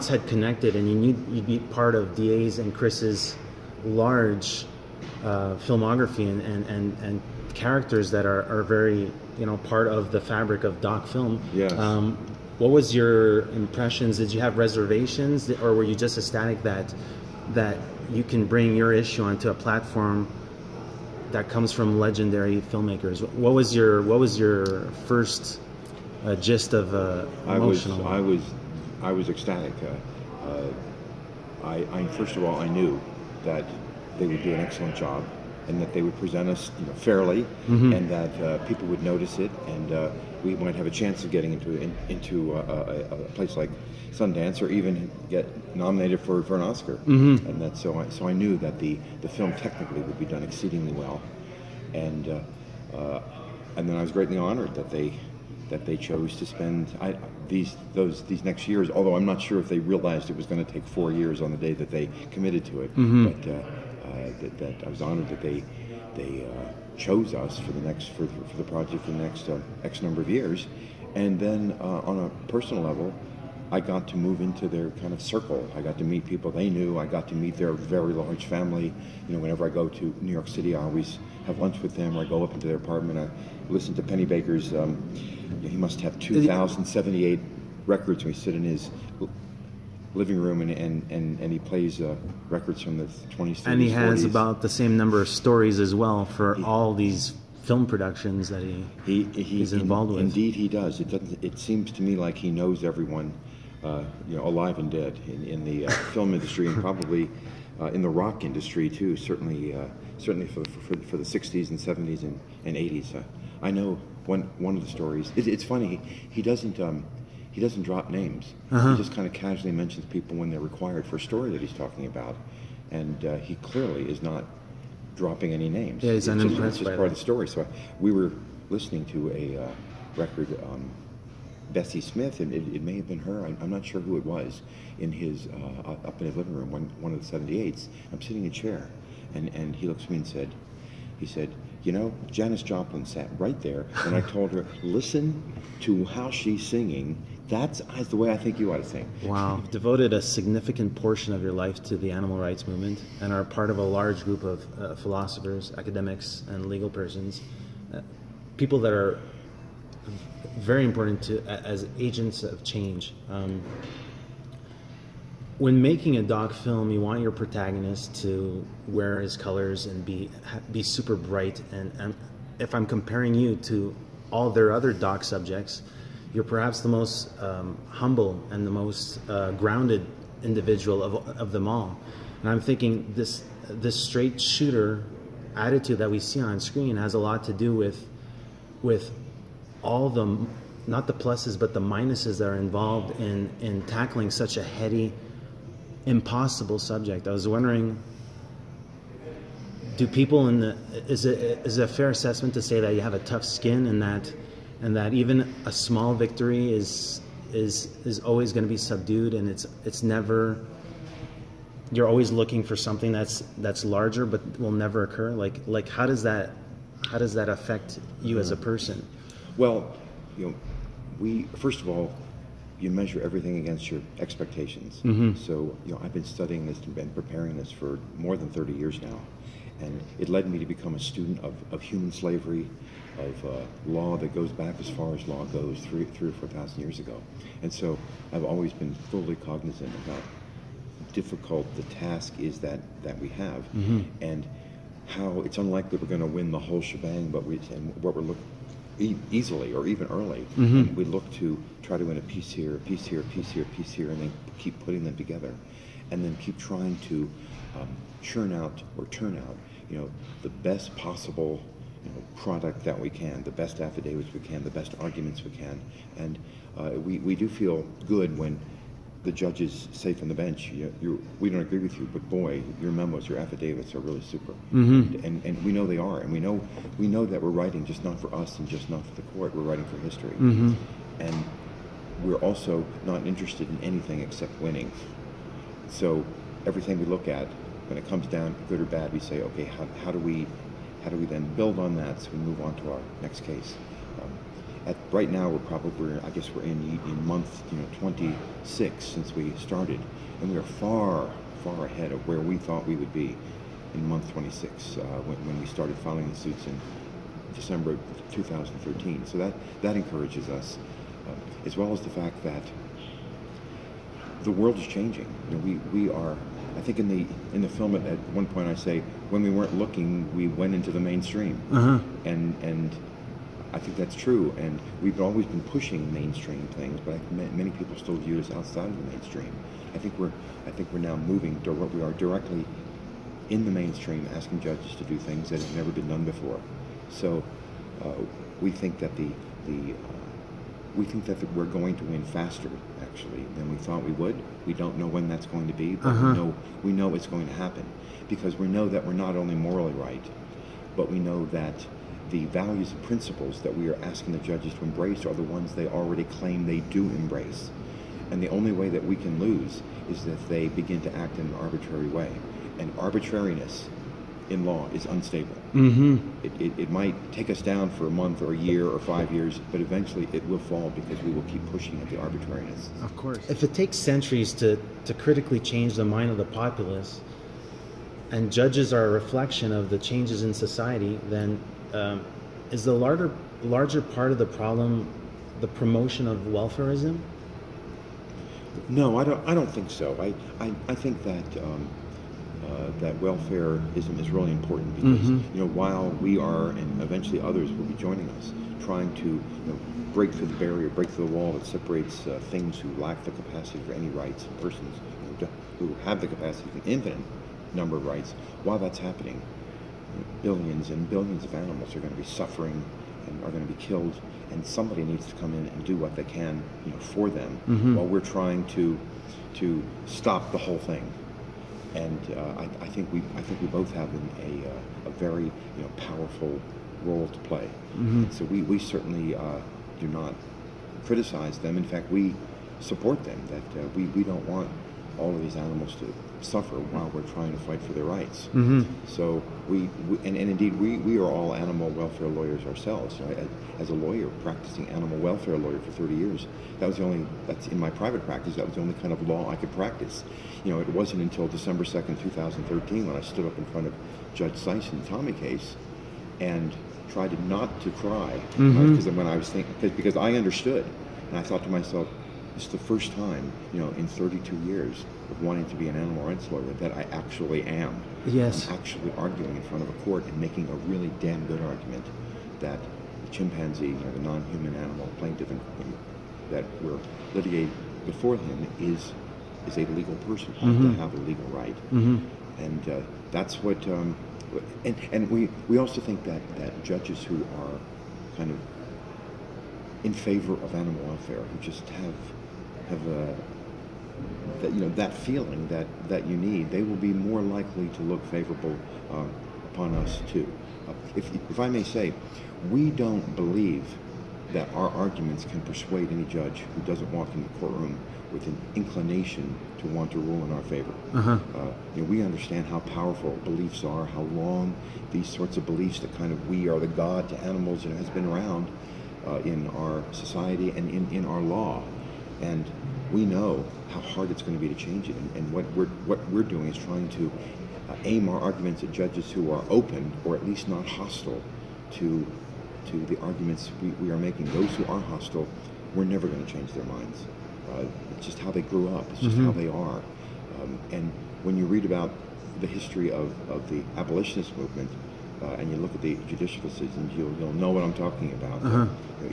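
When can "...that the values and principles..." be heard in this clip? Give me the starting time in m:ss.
5:51.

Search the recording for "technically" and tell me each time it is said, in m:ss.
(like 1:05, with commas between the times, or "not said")
0:49.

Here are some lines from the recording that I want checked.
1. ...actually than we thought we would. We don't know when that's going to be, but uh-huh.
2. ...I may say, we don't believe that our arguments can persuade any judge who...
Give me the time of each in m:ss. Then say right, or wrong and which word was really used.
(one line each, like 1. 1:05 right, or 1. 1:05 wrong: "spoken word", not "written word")
1. 5:43 right
2. 8:21 right.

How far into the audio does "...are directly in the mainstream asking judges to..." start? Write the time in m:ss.
5:32.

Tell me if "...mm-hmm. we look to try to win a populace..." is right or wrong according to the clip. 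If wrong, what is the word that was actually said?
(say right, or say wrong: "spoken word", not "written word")
wrong: "piece", not "populace".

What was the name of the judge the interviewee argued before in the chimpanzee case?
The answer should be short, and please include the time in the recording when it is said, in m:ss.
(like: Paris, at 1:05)
Judge Sise, at 7:34.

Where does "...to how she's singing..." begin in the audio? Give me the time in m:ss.
2:25.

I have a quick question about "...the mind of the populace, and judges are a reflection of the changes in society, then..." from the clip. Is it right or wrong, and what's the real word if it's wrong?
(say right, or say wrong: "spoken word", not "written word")
right.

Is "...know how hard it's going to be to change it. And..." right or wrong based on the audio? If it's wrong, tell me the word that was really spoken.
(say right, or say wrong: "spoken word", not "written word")
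right.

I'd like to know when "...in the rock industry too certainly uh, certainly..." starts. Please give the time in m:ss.
1:47.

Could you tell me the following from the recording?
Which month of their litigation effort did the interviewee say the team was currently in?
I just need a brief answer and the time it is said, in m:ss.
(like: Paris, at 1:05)
month 26, at 4:57.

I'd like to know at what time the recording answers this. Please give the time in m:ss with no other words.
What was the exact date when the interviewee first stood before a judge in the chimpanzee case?
7:31.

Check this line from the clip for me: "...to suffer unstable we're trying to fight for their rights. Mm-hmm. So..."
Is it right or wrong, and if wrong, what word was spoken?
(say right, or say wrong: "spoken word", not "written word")
wrong: "while", not "unstable".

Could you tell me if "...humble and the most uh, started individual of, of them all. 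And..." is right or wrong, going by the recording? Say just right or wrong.
wrong.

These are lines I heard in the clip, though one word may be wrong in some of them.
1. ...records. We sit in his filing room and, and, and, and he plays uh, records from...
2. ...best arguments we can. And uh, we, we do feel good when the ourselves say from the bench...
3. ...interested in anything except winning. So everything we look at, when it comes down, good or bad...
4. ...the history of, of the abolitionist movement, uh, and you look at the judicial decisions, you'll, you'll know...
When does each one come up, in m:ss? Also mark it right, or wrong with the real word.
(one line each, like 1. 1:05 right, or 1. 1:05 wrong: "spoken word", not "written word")
1. 1:27 wrong: "living", not "filing"
2. 4:24 wrong: "judges", not "ourselves"
3. 4:43 right
4. 9:02 right.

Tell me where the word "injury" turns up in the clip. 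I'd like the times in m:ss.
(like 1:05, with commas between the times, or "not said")
not said.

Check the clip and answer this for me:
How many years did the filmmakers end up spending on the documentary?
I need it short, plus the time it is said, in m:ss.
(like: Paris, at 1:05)
4 years, at 1:00.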